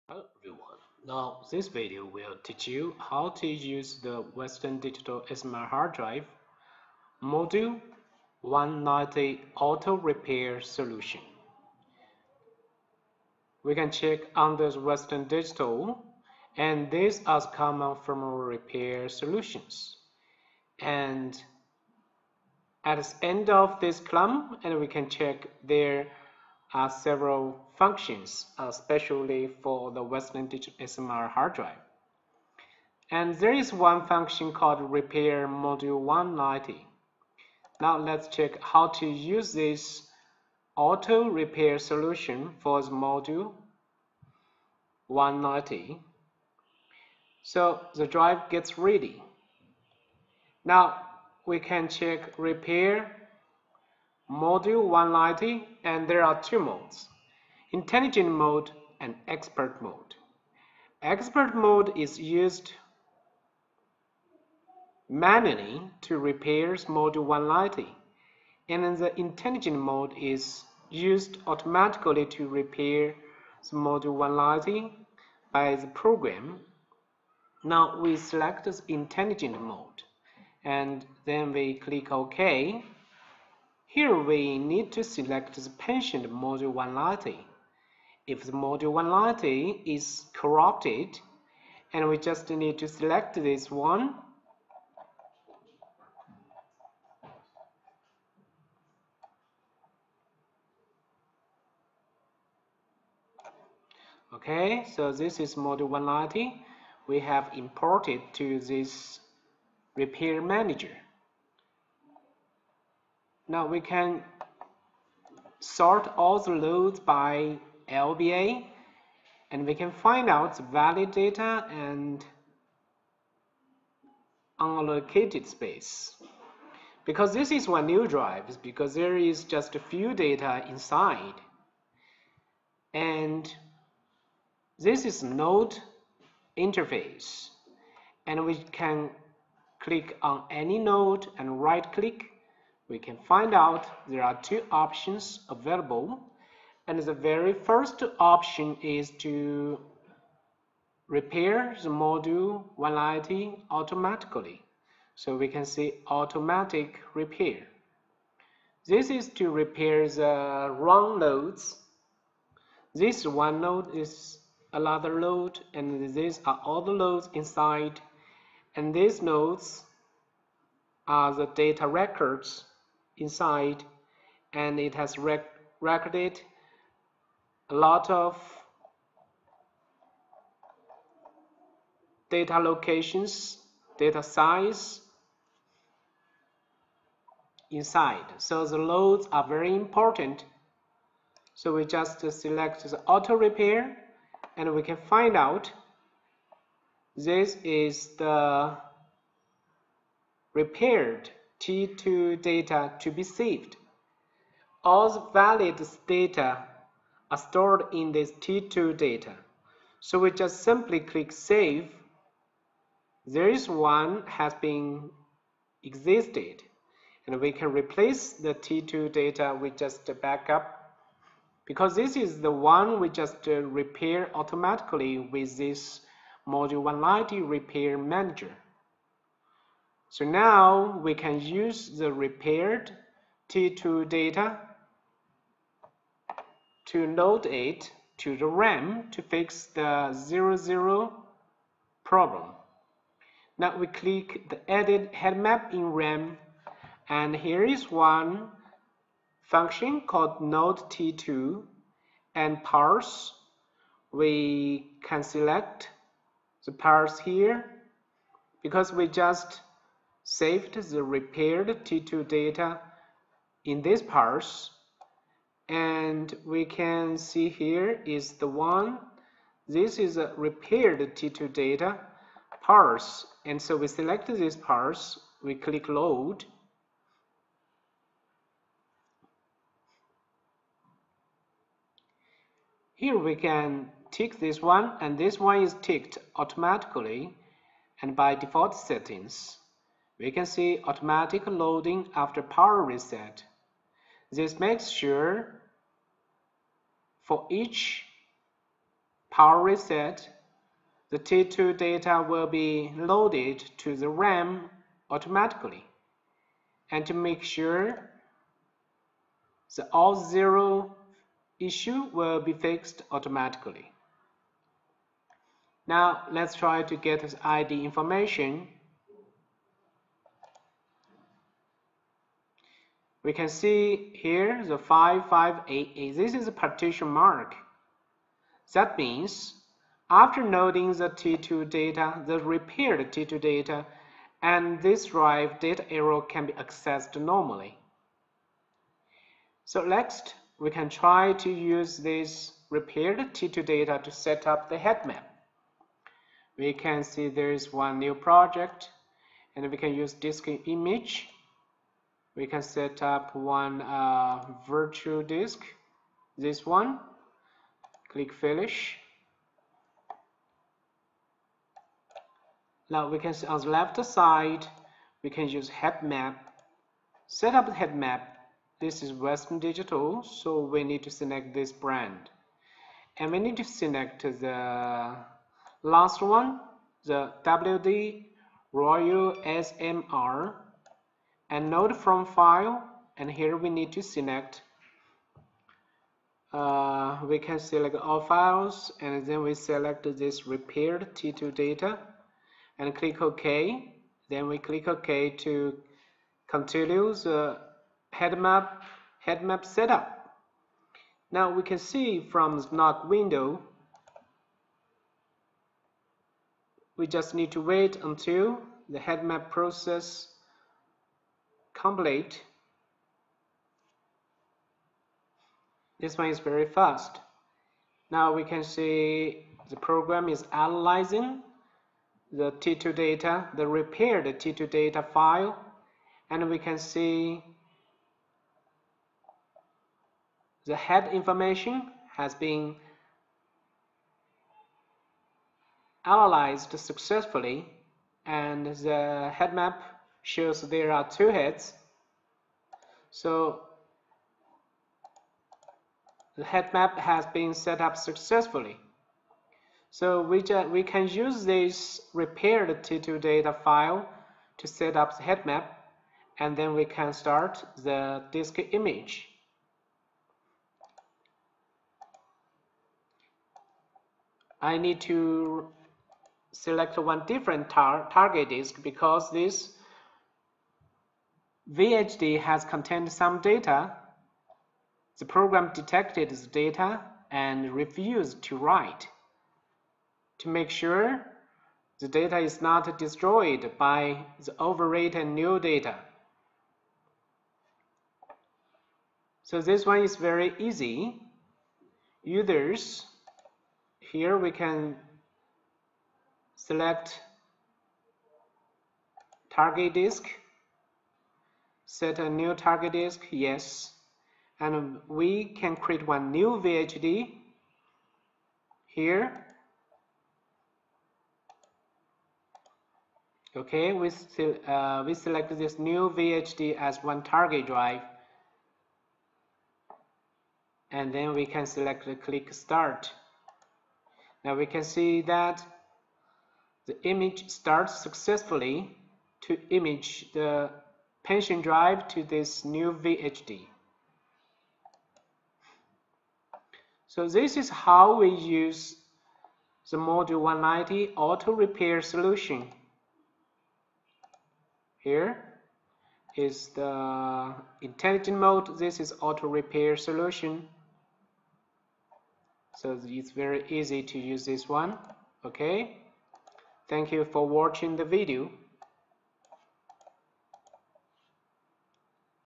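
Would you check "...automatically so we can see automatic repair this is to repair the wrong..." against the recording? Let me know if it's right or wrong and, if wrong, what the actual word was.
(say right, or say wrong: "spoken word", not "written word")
right.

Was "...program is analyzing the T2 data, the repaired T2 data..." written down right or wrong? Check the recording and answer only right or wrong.
right.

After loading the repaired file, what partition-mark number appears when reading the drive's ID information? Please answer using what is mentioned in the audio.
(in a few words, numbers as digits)
5588.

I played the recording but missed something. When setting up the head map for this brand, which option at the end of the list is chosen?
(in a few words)
WD Royl SMR.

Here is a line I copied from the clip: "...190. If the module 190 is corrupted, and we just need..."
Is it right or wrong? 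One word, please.
right.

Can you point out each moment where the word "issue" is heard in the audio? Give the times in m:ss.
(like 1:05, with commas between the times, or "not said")
5:11.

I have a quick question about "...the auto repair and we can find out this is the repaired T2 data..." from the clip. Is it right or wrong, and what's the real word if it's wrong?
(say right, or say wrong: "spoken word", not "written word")
right.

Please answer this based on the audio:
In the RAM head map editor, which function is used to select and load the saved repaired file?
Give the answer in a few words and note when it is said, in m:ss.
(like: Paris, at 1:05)
Node T2, at 4:10.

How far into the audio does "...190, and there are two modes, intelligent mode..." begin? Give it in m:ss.
0:54.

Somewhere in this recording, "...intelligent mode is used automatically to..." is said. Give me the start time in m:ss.
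1:09.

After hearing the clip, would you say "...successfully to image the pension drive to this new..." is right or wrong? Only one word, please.
right.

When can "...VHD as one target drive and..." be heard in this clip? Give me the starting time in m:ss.
8:36.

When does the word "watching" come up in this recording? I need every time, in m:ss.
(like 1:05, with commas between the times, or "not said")
9:17.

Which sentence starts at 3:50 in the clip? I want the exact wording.
So now we can use the repaired T2 data to load it to the RAM to fix the 00 problem.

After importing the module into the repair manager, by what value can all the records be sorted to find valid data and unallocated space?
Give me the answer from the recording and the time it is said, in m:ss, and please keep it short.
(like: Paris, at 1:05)
LBA, at 1:57.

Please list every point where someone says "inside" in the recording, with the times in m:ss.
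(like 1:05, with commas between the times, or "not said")
2:10, 2:47, 2:53, 3:07.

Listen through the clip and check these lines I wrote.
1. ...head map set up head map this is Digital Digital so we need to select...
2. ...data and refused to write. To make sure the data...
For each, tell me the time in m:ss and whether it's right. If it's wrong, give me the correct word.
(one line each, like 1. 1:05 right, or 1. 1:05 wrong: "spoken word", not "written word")
1. 6:05 wrong: "Western", not "Digital"
2. 7:56 right.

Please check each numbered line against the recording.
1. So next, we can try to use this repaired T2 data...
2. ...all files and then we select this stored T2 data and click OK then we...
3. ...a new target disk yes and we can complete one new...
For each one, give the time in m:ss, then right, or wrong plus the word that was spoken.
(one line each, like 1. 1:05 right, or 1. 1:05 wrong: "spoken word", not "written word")
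1. 5:39 right
2. 6:27 wrong: "repaired", not "stored"
3. 8:22 wrong: "create", not "complete".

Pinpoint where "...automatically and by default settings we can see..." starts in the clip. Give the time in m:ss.
4:46.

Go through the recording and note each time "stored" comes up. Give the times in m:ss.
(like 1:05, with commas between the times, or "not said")
3:27.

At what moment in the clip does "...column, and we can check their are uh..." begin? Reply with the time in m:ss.
0:23.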